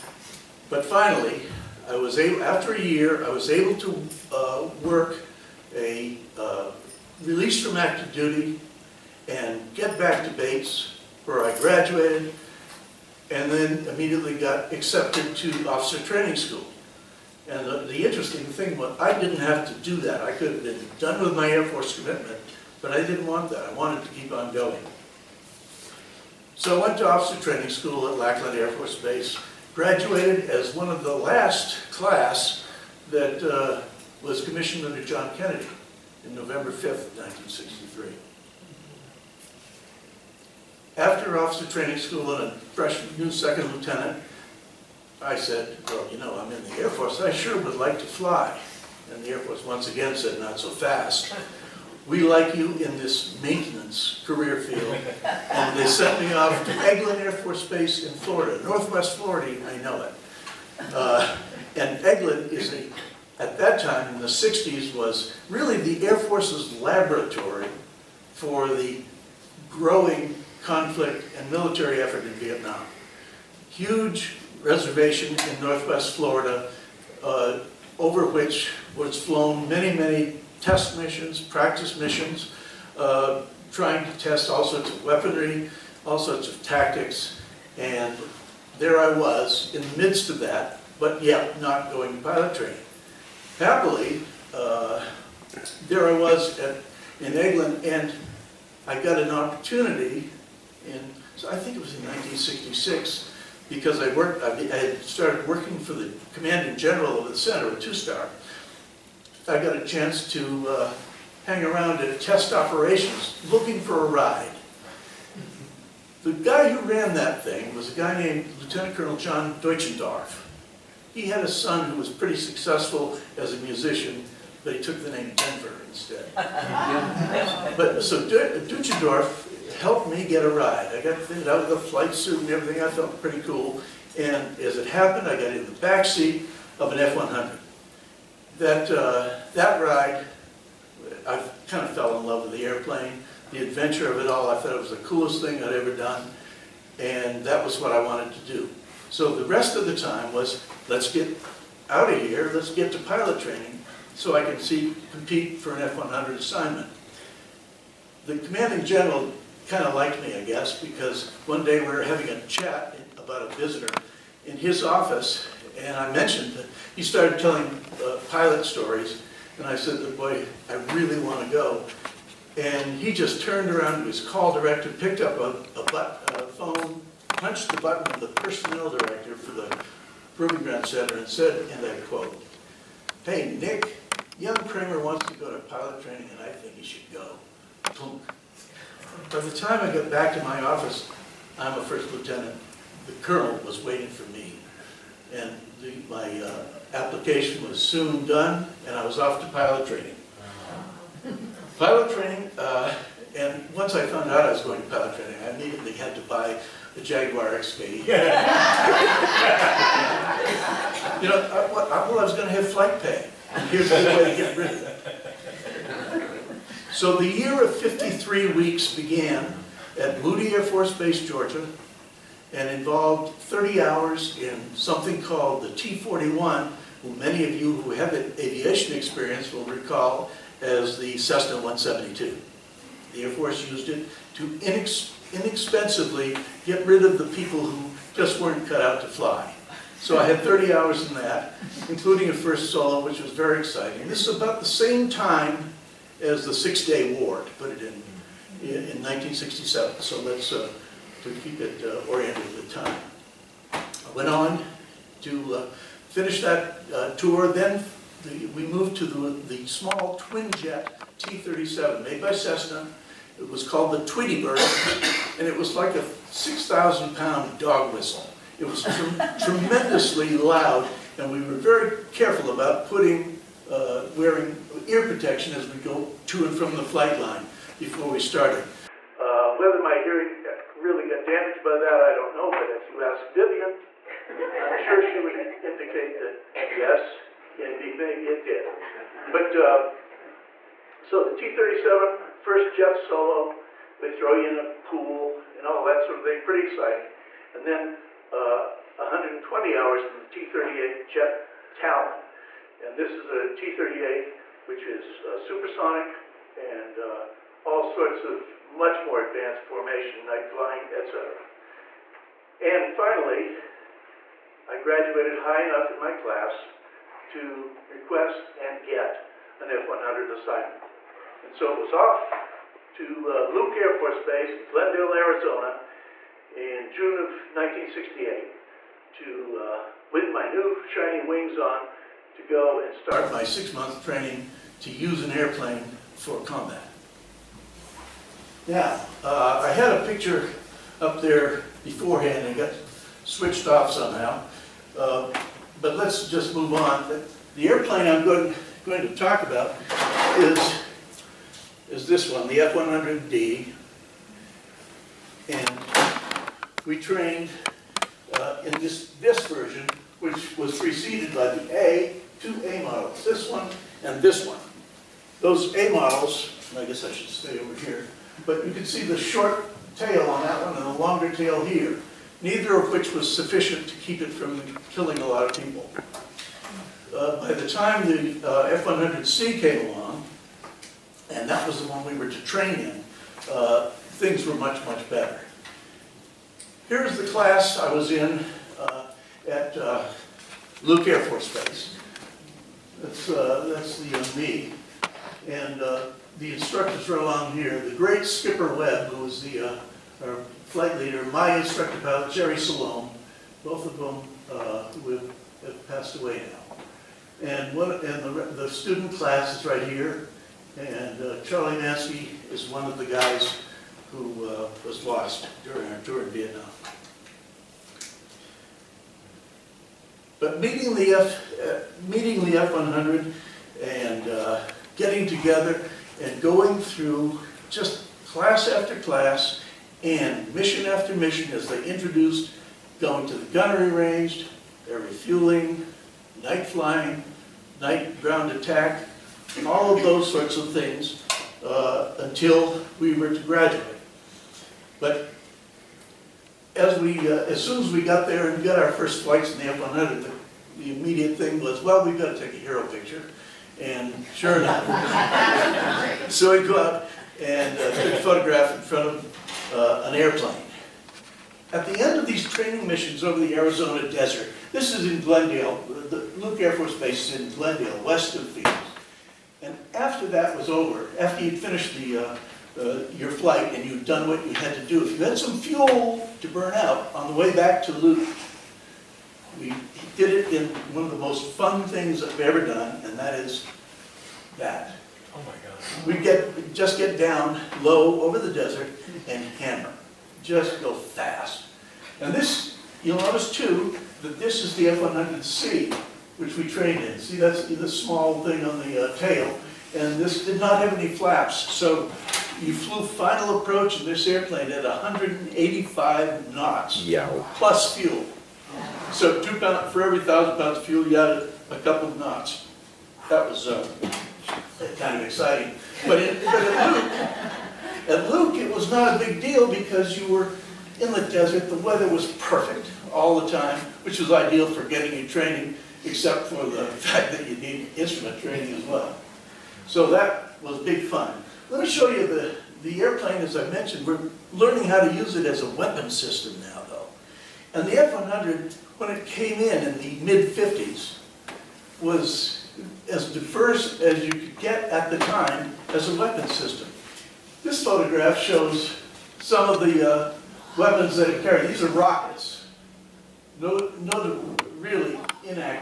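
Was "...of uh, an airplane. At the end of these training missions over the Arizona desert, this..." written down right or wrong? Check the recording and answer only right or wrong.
right.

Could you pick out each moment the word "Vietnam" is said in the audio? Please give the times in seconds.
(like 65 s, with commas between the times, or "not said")
72 s, 416 s.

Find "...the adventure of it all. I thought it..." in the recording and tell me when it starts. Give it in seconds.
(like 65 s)
143 s.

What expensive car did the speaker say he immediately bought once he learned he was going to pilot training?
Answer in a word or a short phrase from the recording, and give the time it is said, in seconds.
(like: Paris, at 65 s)
Jaguar XP, at 207 s.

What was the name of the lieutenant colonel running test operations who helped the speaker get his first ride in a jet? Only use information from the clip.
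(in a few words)
John Deutschendorf.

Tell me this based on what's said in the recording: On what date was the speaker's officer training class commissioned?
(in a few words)
November 5th, 1963.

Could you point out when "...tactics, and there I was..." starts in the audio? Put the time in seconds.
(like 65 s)
86 s.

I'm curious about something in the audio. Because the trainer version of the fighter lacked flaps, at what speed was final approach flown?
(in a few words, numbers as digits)
185 knots.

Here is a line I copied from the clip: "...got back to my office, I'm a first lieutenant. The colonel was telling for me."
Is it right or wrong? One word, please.
wrong.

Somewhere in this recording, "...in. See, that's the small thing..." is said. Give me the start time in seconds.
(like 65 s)
497 s.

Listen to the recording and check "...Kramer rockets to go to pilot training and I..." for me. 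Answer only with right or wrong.
wrong.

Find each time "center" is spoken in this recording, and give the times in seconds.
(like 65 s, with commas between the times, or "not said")
107 s, 180 s.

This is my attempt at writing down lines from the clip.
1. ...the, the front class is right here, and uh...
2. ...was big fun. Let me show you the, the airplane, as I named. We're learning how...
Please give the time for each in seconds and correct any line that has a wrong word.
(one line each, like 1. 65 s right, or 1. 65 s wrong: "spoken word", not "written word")
1. 408 s wrong: "student", not "front"
2. 530 s wrong: "mentioned", not "named".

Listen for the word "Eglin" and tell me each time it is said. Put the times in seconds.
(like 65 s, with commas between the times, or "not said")
56 s, 62 s.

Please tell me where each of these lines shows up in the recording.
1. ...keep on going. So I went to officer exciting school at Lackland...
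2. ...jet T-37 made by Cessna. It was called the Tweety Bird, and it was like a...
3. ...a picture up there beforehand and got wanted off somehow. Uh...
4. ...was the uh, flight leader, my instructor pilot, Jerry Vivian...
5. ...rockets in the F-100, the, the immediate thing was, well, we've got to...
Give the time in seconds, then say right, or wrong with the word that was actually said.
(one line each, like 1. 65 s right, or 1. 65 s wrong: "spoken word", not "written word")
1. 24 s wrong: "training", not "exciting"
2. 260 s right
3. 339 s wrong: "switched", not "wanted"
4. 399 s wrong: "Salome", not "Vivian"
5. 449 s wrong: "flights", not "rockets".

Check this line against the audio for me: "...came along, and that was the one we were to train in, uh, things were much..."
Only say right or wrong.
right.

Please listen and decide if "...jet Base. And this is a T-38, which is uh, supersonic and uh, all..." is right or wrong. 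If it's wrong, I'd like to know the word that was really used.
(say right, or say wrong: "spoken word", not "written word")
wrong: "Talon", not "Base".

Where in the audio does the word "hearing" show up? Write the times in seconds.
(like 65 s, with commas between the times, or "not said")
279 s.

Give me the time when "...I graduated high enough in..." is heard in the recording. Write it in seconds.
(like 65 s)
314 s.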